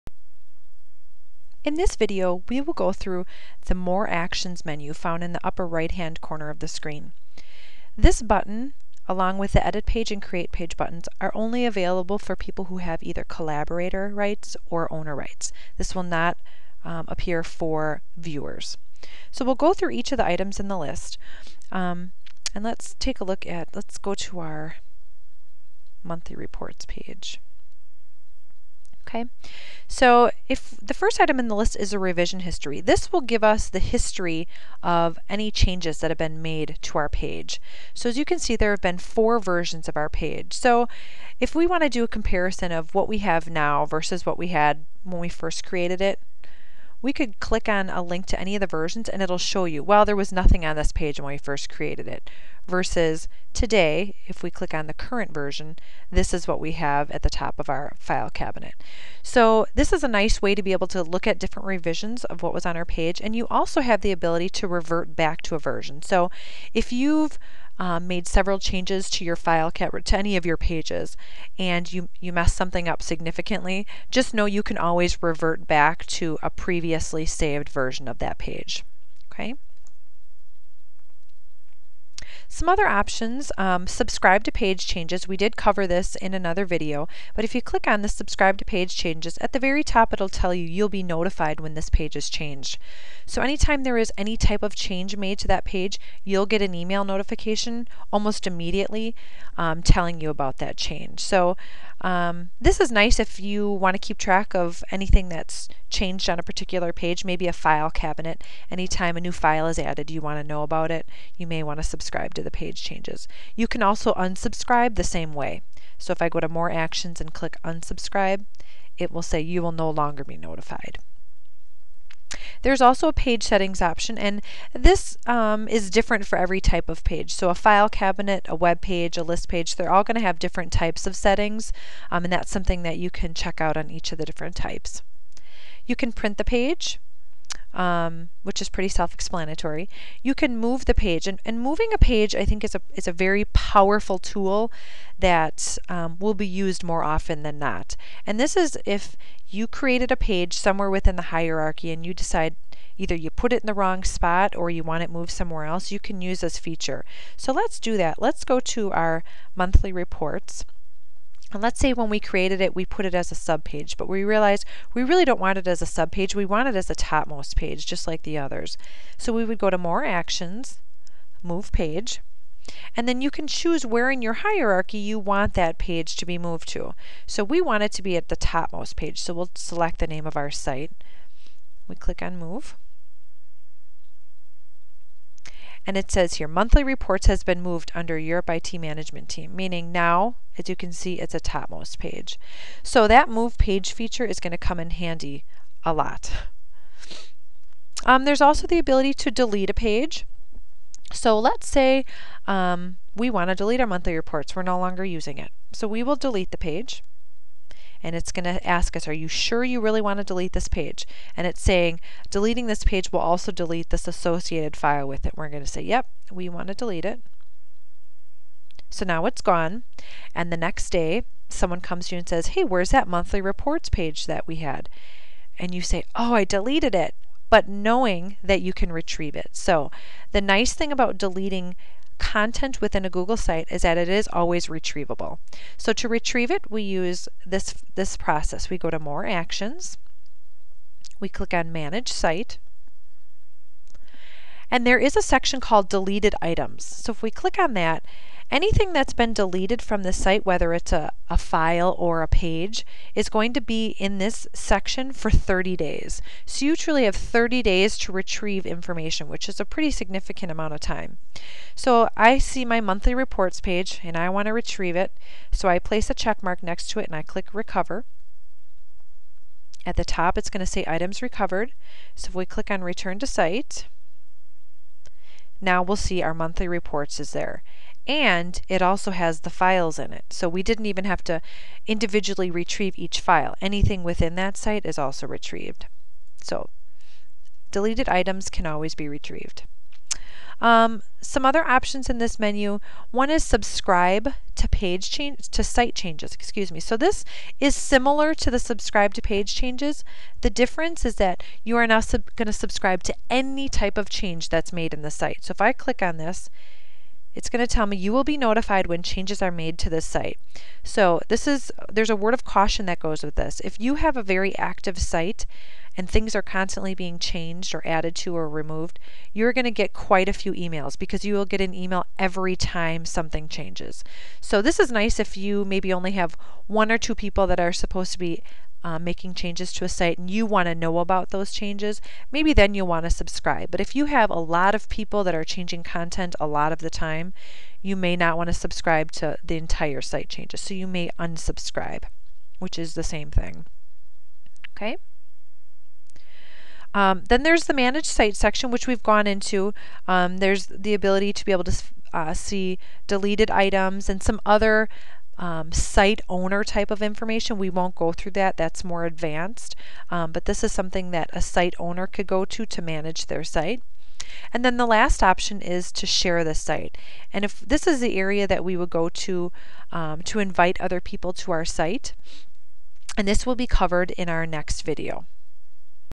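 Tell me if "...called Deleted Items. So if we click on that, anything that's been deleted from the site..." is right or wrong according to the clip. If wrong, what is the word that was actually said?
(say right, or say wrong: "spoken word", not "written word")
right.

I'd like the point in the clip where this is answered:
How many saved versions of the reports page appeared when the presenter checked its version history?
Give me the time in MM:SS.
00:38.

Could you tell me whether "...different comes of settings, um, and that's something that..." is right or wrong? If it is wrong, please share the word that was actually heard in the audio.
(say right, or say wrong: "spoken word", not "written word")
wrong: "types", not "comes".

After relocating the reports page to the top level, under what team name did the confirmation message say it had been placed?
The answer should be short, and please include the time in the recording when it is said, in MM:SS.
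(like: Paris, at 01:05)
Europe IT management team, at 03:08.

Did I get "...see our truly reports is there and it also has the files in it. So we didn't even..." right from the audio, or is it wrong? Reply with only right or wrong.
wrong.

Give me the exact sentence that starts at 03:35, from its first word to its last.
We're going to say, Yep, we want to delete it.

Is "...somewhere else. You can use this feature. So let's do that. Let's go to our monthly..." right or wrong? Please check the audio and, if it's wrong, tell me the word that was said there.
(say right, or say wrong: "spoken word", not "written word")
right.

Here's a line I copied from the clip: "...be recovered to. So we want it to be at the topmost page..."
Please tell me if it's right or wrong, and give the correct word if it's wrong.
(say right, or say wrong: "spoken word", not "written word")
wrong: "moved", not "recovered".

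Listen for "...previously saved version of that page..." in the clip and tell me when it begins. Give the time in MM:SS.
01:16.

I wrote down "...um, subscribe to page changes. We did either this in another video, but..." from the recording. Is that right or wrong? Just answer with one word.
wrong.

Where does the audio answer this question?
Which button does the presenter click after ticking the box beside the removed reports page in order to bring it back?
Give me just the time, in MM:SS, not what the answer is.
04:27.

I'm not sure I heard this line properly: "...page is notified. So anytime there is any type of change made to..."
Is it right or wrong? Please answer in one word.
wrong.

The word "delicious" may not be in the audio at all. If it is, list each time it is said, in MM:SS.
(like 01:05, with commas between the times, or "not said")
not said.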